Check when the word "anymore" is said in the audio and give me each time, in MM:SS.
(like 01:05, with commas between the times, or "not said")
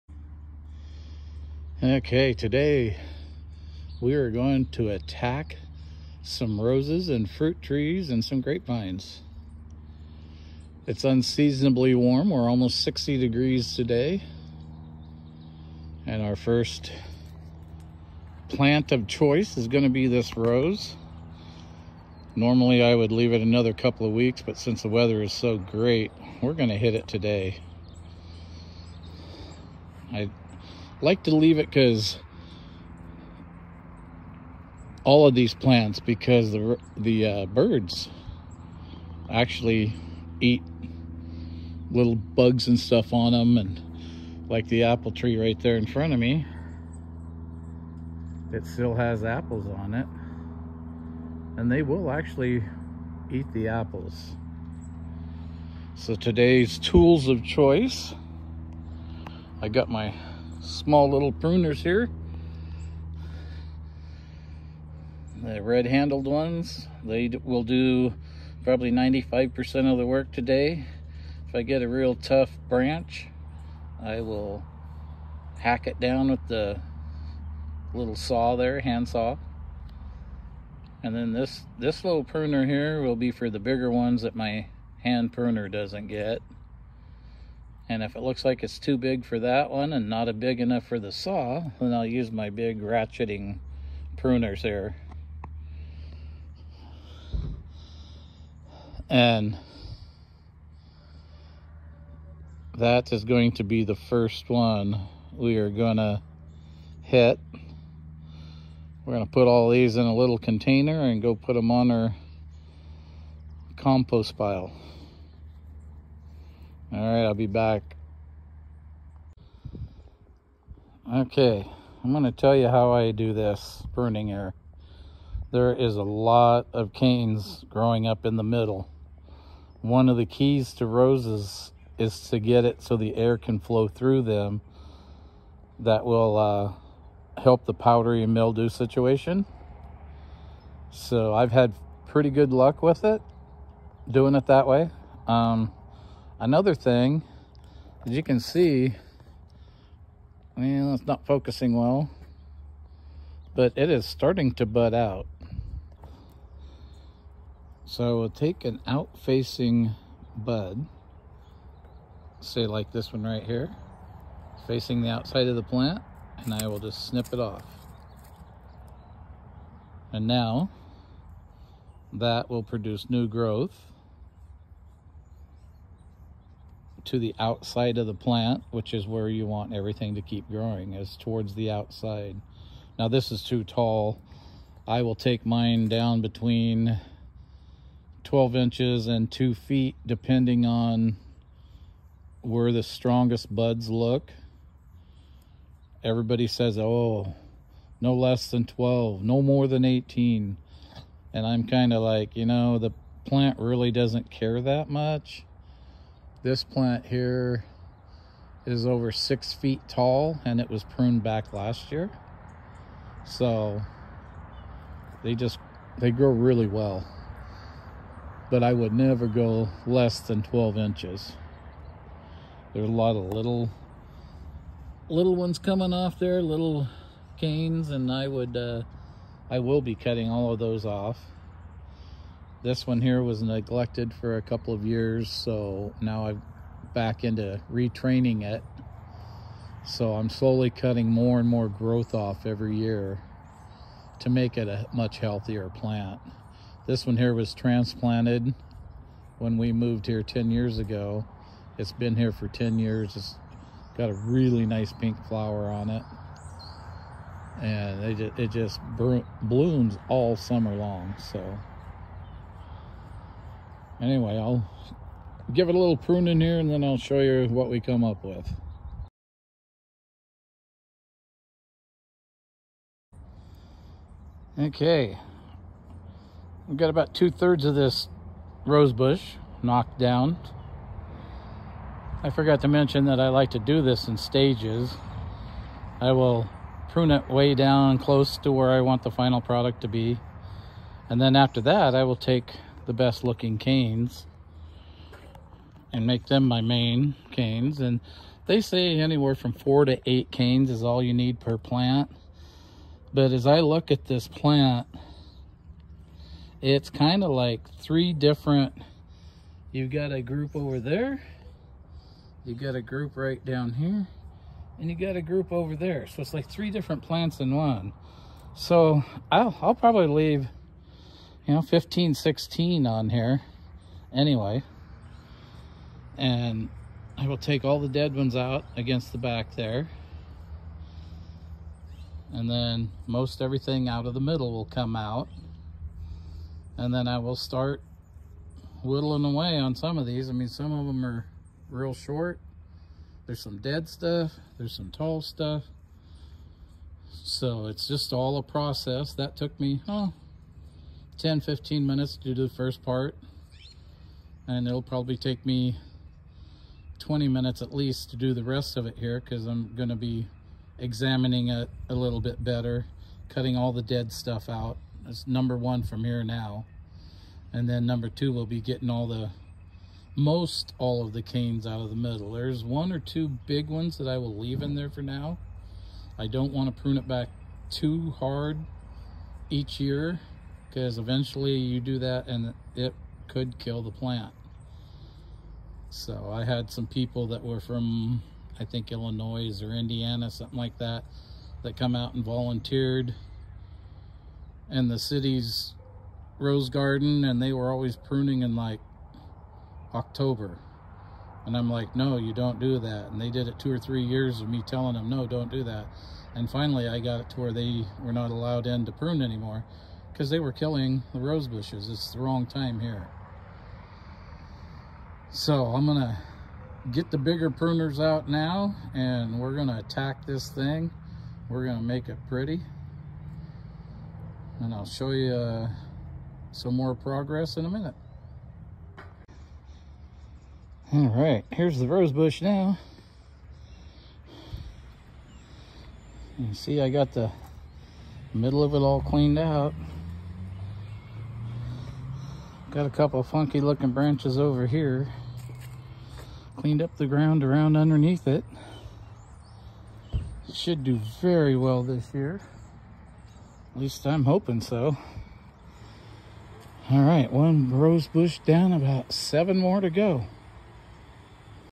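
06:49.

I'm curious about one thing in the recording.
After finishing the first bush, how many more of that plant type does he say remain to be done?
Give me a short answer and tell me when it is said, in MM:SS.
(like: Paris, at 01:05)
7, at 07:39.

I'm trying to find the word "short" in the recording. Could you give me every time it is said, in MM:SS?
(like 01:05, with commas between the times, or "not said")
05:41.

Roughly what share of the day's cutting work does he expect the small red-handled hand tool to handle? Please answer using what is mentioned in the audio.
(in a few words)
95%.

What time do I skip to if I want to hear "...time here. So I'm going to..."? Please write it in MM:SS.
06:52.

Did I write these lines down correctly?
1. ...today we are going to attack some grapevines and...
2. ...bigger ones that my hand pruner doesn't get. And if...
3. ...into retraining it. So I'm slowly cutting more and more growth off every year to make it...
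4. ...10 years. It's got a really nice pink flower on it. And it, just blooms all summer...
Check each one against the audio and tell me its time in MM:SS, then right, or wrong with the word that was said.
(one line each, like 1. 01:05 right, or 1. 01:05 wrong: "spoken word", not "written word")
1. 00:02 wrong: "roses", not "grapevines"
2. 01:23 right
3. 03:57 right
4. 04:12 right.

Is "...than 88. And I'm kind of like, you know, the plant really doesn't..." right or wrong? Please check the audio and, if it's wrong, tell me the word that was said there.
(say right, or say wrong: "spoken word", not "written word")
wrong: "18", not "88".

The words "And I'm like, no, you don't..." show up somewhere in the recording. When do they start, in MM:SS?
06:41.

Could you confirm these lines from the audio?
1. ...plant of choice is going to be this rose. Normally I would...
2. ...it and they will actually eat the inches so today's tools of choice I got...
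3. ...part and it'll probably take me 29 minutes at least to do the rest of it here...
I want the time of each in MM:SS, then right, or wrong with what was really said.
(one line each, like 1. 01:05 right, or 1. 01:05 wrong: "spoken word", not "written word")
1. 00:18 right
2. 00:49 wrong: "apples", not "inches"
3. 05:52 wrong: "20", not "29".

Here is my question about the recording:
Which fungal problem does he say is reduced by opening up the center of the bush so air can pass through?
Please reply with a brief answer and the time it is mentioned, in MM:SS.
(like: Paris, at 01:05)
powdery mildew, at 02:17.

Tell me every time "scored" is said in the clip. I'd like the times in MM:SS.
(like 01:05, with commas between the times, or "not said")
not said.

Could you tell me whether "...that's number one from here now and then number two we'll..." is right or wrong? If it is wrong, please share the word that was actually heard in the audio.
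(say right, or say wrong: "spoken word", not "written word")
right.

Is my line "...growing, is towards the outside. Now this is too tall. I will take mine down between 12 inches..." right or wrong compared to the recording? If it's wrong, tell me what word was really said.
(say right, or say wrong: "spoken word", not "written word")
right.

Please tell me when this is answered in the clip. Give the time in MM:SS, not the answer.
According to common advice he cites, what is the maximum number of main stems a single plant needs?
05:00.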